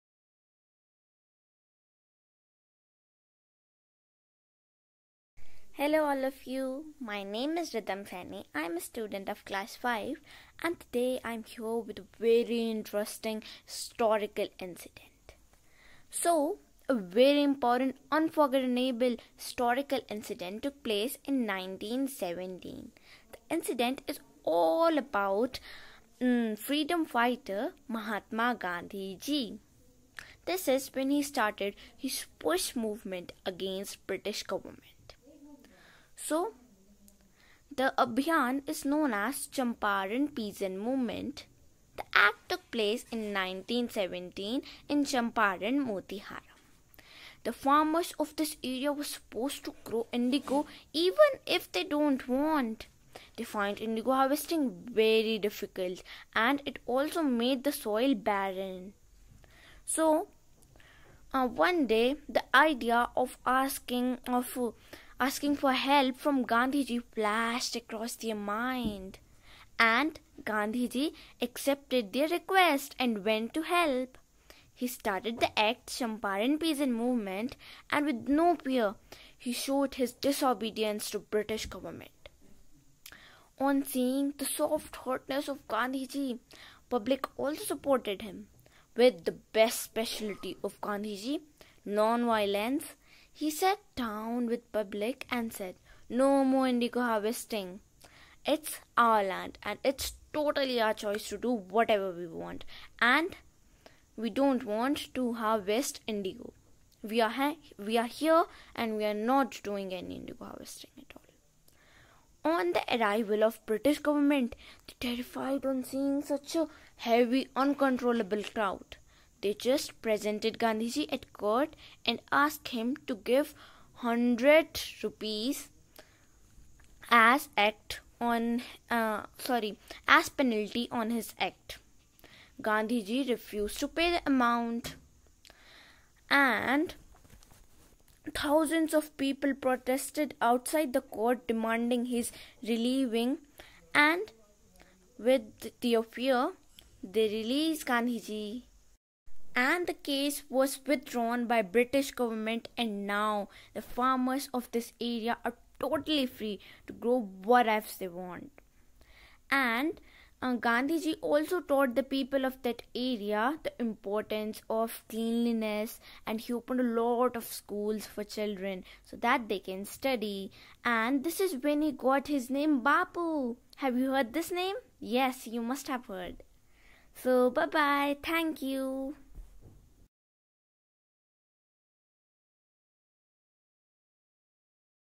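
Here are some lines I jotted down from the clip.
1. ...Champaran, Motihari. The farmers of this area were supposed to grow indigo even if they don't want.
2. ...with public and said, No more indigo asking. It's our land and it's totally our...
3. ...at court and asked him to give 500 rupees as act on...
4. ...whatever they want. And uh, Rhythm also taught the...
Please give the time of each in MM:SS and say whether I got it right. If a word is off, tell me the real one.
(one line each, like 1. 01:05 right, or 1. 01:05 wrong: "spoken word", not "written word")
1. 00:45 right
2. 01:34 wrong: "harvesting", not "asking"
3. 02:01 wrong: "100", not "500"
4. 02:37 wrong: "Gandhiji", not "Rhythm".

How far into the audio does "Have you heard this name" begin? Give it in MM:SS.
02:53.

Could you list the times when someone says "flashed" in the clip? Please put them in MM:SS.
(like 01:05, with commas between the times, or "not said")
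01:07.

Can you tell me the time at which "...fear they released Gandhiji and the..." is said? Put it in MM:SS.
02:26.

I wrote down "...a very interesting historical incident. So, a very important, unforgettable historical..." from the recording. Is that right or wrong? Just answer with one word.
right.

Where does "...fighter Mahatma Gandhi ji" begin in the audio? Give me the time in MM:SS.
00:27.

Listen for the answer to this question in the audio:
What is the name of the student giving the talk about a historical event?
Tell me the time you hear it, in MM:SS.
00:07.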